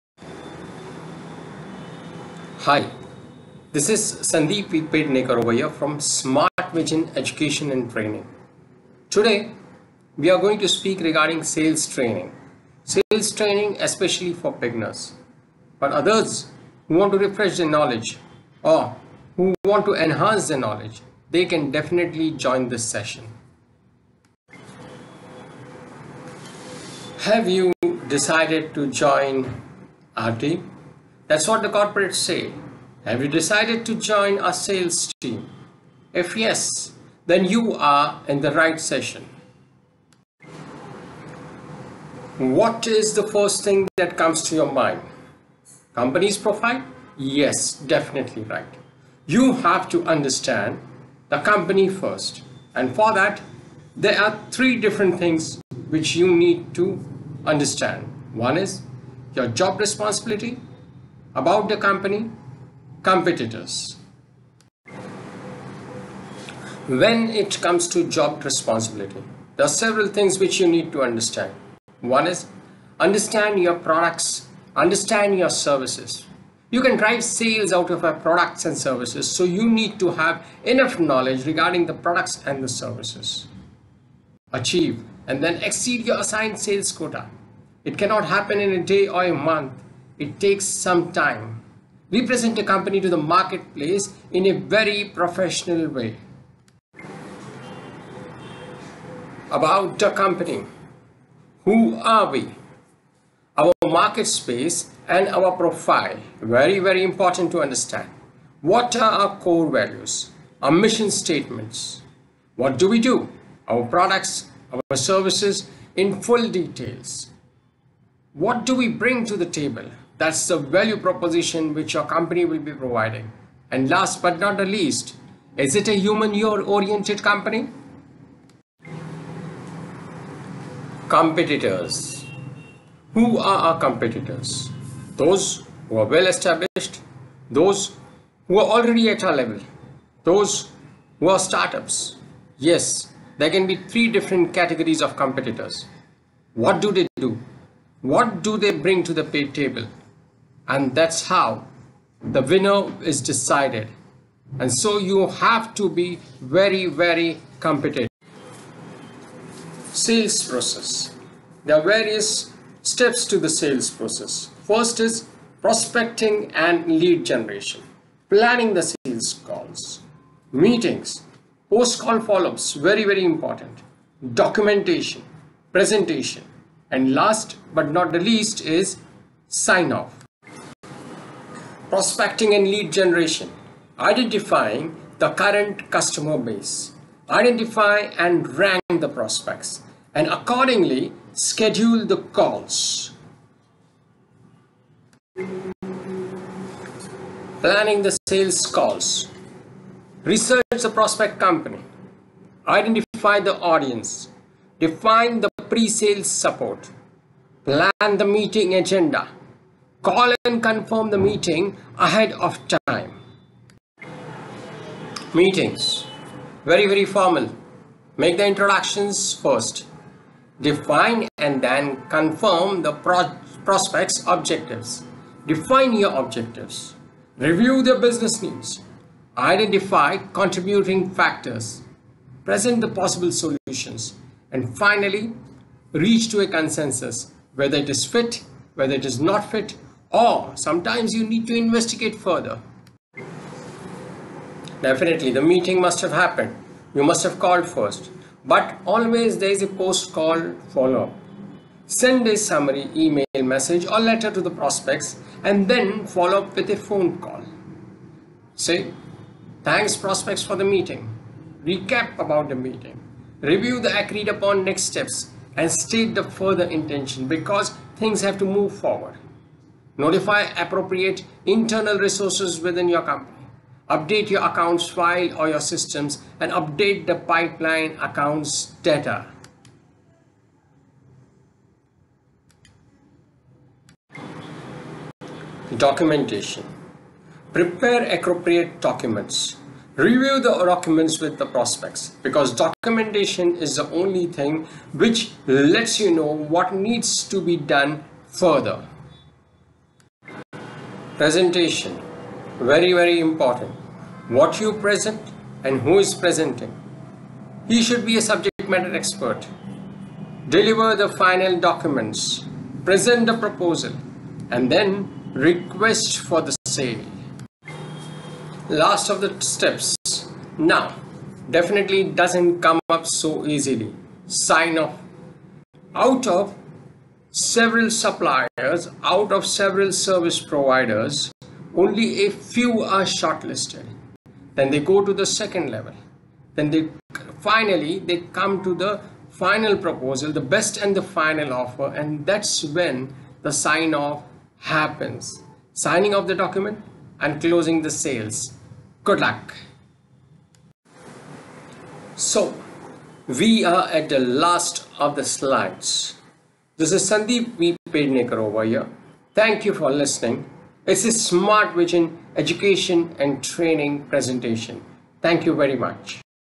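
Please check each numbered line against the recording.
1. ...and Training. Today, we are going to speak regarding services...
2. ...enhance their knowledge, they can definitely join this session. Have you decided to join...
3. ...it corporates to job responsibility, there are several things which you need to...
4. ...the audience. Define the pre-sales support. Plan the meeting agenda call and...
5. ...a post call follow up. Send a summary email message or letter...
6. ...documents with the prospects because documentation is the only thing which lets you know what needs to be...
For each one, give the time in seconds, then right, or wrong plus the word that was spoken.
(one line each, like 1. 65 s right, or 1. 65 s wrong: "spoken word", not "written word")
1. 7 s wrong: "sales", not "services"
2. 19 s right
3. 67 s wrong: "comes", not "corporates"
4. 203 s right
5. 249 s right
6. 290 s right.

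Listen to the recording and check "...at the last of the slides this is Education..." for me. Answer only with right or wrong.
wrong.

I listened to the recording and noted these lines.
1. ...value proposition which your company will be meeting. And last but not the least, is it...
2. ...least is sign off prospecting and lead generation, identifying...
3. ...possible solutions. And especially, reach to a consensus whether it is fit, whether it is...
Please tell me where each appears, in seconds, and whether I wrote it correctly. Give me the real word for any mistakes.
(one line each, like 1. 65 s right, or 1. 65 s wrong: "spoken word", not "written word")
1. 120 s wrong: "providing", not "meeting"
2. 178 s right
3. 232 s wrong: "finally", not "especially".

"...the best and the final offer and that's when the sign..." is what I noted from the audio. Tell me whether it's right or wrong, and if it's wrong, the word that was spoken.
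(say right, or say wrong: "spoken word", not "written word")
right.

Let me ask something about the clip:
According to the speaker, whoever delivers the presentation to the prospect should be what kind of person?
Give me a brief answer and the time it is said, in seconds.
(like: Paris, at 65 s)
subject matter expert, at 308 s.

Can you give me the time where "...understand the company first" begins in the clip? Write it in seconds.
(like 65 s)
50 s.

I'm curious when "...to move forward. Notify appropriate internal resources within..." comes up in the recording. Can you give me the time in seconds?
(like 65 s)
268 s.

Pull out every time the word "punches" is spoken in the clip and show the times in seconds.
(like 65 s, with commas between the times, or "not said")
not said.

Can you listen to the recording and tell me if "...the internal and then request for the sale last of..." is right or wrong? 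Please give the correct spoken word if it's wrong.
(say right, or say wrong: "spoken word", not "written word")
wrong: "proposal", not "internal".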